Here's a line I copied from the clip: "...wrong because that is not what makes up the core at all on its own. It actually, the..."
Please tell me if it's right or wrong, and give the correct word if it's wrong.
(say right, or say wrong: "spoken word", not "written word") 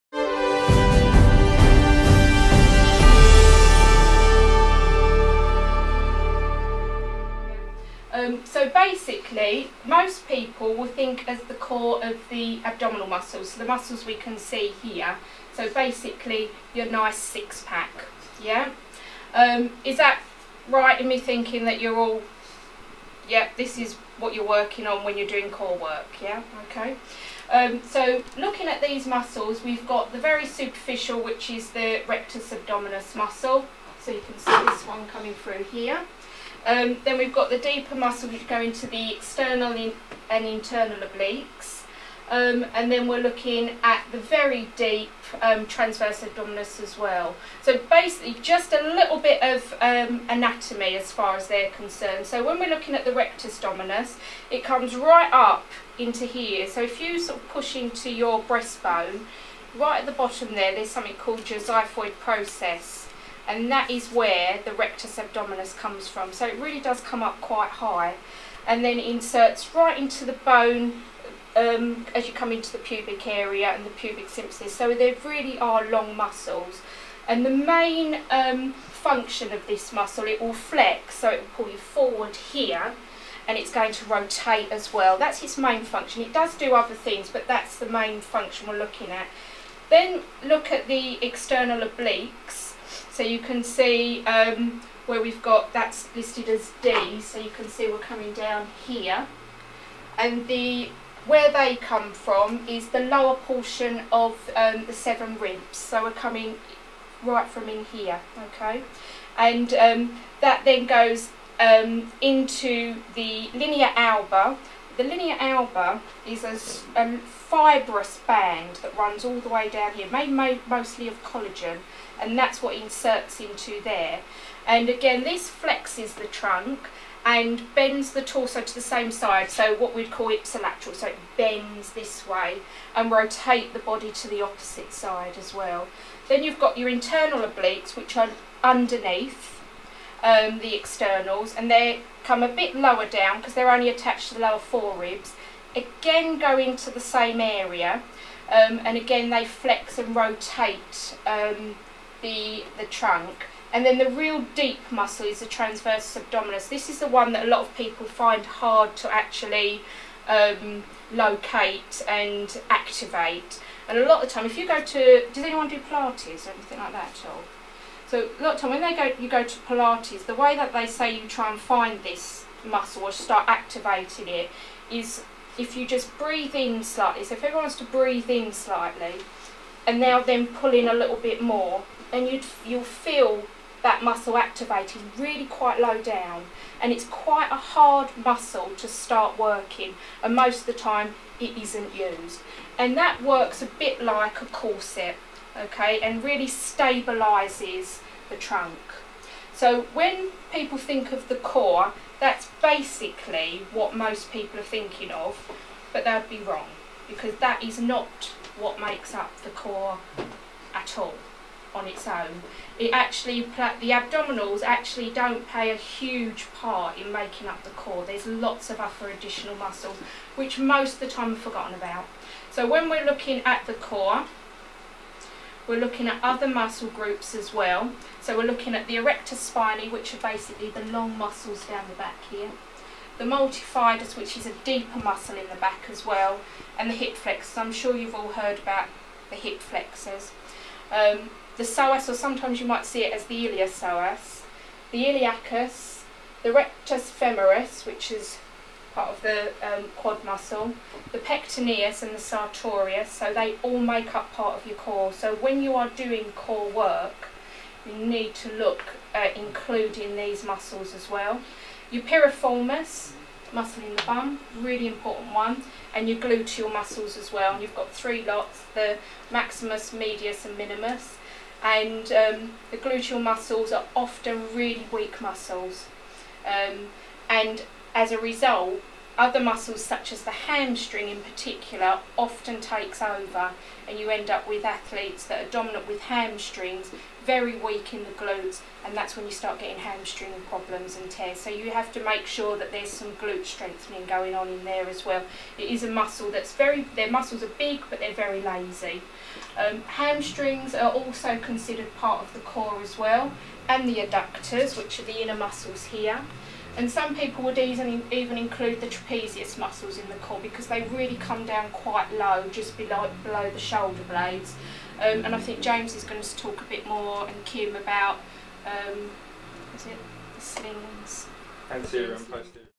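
right.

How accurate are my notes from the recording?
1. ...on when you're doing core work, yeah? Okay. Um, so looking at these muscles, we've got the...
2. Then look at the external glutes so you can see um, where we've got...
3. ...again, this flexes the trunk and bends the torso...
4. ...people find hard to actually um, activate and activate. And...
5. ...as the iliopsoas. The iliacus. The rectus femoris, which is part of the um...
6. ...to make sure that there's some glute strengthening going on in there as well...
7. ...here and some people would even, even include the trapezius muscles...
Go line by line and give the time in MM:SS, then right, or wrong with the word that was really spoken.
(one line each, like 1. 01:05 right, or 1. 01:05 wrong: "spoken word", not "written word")
1. 00:24 right
2. 01:29 wrong: "obliques", not "glutes"
3. 02:04 right
4. 02:37 wrong: "locate", not "activate"
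5. 04:03 right
6. 04:51 right
7. 05:05 right.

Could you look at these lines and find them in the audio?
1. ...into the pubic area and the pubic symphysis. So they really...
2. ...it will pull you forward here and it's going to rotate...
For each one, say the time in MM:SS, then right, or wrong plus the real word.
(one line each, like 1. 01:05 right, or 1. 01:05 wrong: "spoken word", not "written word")
1. 01:12 right
2. 01:21 right.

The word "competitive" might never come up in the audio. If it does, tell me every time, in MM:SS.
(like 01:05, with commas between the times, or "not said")
not said.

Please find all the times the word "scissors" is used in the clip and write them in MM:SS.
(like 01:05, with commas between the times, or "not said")
not said.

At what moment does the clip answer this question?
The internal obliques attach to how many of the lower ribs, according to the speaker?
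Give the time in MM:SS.
02:24.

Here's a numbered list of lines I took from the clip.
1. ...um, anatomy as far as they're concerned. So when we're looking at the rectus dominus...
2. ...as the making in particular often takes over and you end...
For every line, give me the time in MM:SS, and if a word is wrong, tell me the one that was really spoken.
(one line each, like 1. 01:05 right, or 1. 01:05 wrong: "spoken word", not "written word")
1. 00:49 right
2. 04:40 wrong: "hamstring", not "making".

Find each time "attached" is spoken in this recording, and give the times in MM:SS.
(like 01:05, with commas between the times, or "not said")
02:23.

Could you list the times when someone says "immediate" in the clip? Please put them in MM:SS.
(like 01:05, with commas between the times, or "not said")
not said.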